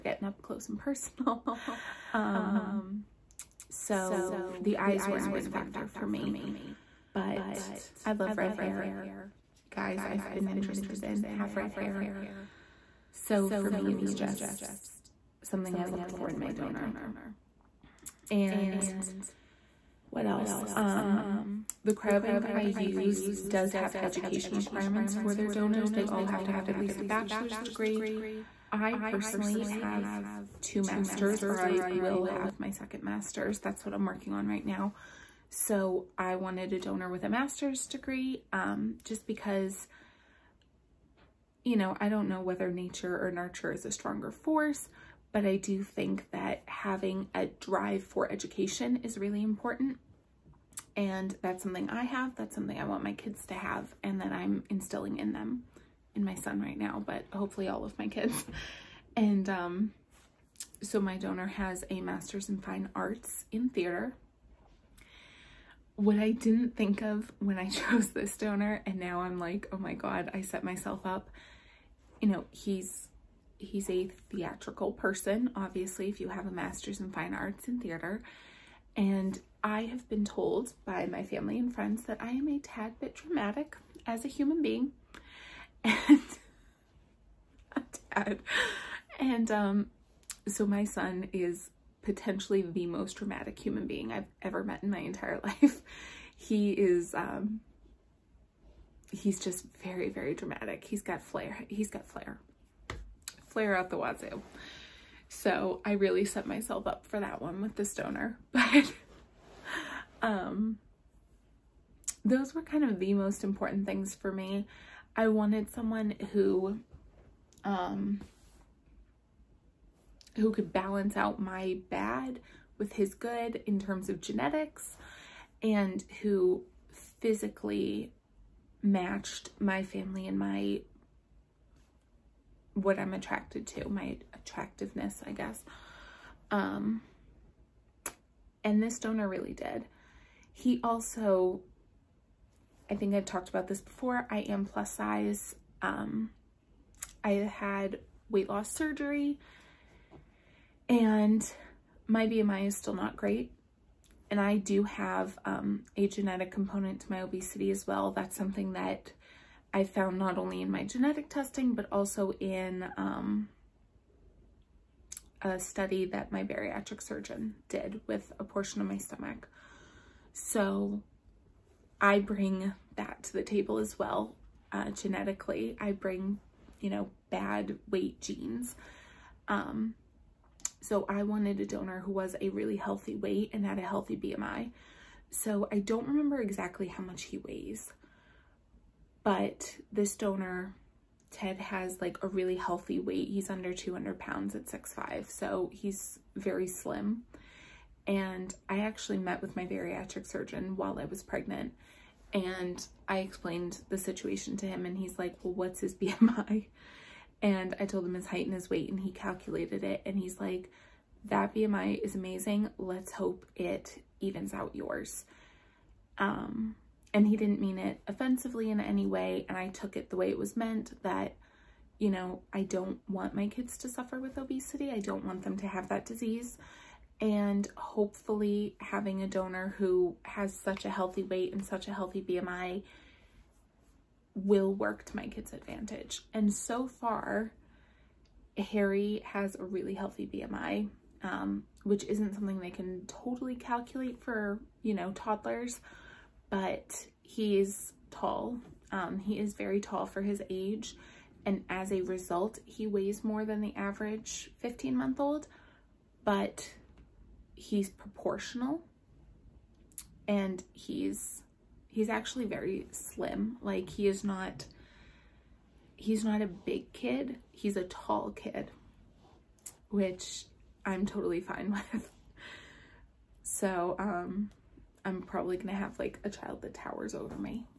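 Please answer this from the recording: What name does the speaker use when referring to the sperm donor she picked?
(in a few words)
Ted.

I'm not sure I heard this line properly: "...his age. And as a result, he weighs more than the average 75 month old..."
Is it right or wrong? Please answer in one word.
wrong.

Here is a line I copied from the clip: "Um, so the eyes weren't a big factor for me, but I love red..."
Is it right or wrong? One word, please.
right.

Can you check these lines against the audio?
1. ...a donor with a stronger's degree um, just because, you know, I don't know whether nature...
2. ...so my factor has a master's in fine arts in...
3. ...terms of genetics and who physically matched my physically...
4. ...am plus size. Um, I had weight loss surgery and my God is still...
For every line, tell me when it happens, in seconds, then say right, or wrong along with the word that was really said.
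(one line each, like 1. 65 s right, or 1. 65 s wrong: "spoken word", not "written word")
1. 36 s wrong: "master", not "stronger"
2. 60 s wrong: "donor", not "factor"
3. 123 s wrong: "family", not "physically"
4. 144 s wrong: "BMI", not "God".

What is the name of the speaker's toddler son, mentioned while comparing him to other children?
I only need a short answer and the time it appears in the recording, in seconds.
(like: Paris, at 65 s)
Harry, at 238 s.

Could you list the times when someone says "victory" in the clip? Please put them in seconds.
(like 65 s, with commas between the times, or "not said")
not said.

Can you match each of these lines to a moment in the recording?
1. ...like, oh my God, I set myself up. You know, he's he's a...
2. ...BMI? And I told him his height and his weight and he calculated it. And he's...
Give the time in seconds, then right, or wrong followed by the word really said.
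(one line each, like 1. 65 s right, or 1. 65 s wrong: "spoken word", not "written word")
1. 69 s right
2. 205 s right.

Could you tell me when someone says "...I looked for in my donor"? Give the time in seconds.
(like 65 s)
15 s.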